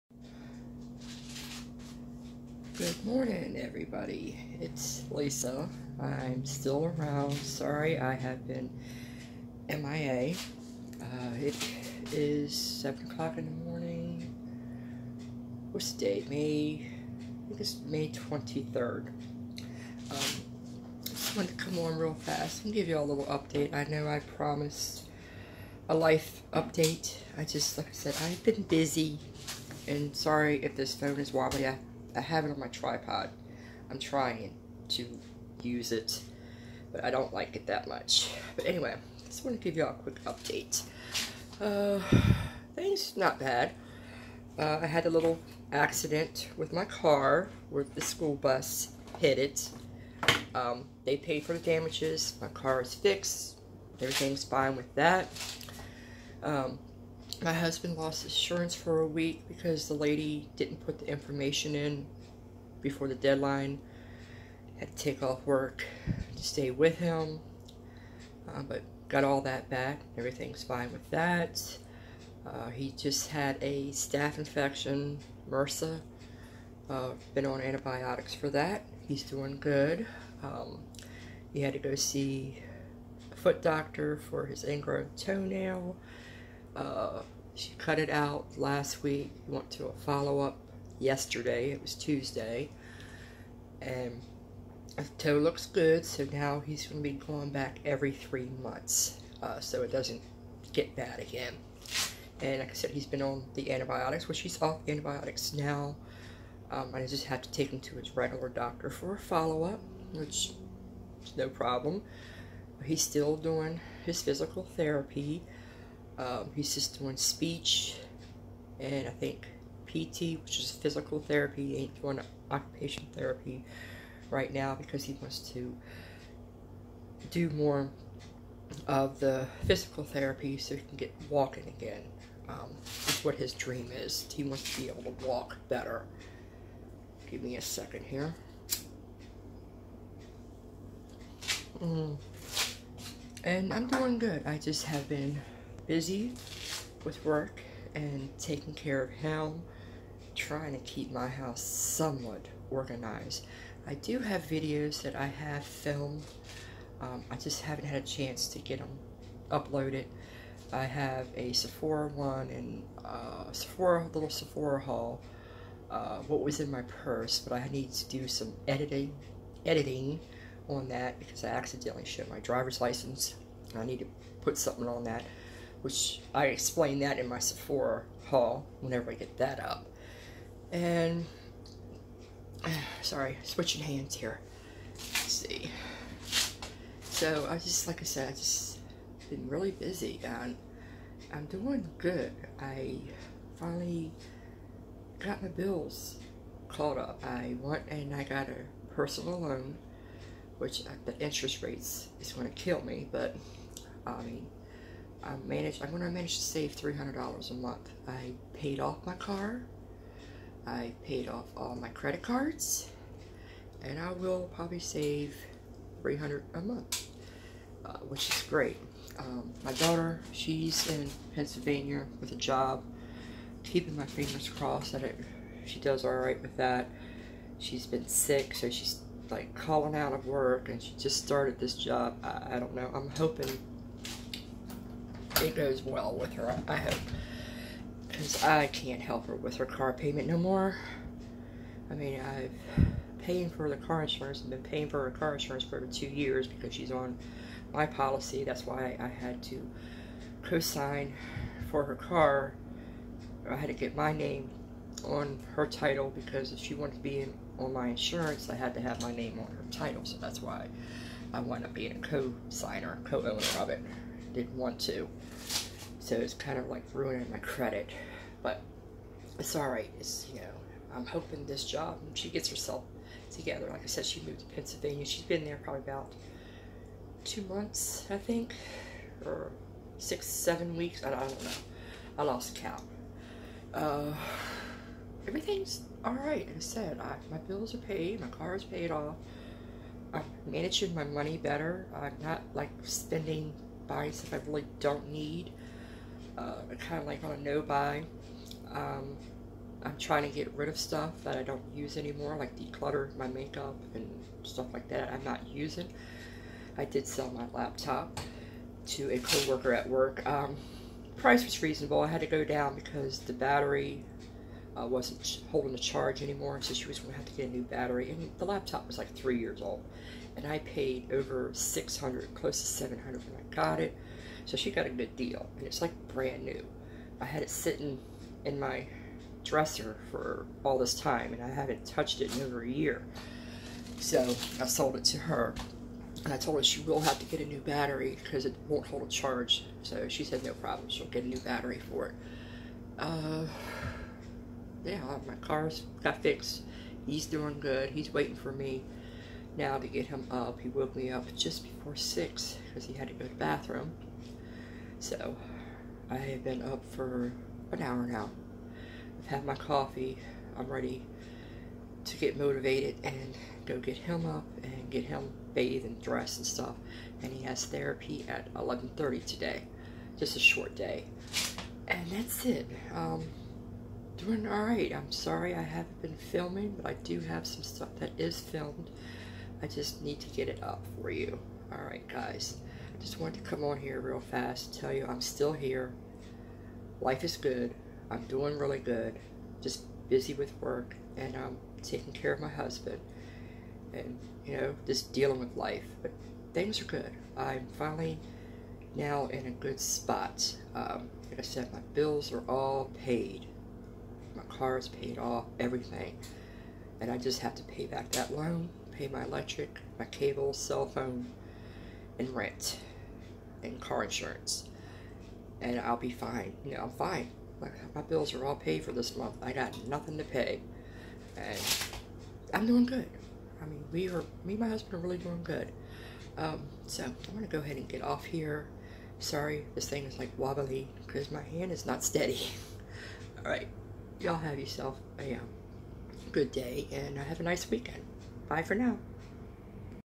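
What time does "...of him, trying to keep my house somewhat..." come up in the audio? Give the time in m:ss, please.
2:29.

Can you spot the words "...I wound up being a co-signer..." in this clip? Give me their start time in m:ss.
4:21.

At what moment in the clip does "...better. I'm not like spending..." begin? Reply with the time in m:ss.
4:51.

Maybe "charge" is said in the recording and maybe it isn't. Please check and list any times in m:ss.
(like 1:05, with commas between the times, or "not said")
5:15, 5:39.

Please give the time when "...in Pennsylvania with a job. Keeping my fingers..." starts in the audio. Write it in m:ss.
3:40.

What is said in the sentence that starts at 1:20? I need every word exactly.
Um, he had to go see a foot doctor for his ingrown toenail.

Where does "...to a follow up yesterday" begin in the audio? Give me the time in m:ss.
1:29.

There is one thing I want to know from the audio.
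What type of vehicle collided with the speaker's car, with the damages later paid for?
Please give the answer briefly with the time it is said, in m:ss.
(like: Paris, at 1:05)
School bus, at 0:48.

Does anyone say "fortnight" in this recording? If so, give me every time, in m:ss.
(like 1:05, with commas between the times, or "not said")
not said.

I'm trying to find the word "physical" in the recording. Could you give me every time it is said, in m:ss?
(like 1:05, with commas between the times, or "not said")
1:54, 2:00, 2:09.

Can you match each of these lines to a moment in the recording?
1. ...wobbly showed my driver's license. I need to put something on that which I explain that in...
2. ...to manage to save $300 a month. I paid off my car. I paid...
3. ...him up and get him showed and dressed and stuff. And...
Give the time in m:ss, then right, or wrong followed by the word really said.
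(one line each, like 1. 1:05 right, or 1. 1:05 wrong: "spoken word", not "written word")
1. 2:51 wrong: "accidentally", not "wobbly"
2. 3:26 right
3. 6:03 wrong: "bathed", not "showed".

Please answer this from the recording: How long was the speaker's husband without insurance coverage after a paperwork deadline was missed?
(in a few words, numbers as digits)
A week.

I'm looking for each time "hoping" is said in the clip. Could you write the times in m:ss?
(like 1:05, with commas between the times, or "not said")
3:53, 4:31.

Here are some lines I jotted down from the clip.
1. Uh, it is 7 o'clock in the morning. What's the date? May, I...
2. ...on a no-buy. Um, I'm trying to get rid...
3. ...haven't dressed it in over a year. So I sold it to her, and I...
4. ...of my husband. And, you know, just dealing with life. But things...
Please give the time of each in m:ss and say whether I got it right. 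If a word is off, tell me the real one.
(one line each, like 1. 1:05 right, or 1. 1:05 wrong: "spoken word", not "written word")
1. 0:10 right
2. 4:57 right
3. 5:31 wrong: "touched", not "dressed"
4. 6:32 right.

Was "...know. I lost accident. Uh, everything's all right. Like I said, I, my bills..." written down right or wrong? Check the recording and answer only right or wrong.
wrong.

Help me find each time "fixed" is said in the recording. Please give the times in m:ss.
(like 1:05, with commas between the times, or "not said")
0:52, 5:46.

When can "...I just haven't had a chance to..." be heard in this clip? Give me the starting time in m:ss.
2:37.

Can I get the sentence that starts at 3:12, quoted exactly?
I finally got my bills caught up.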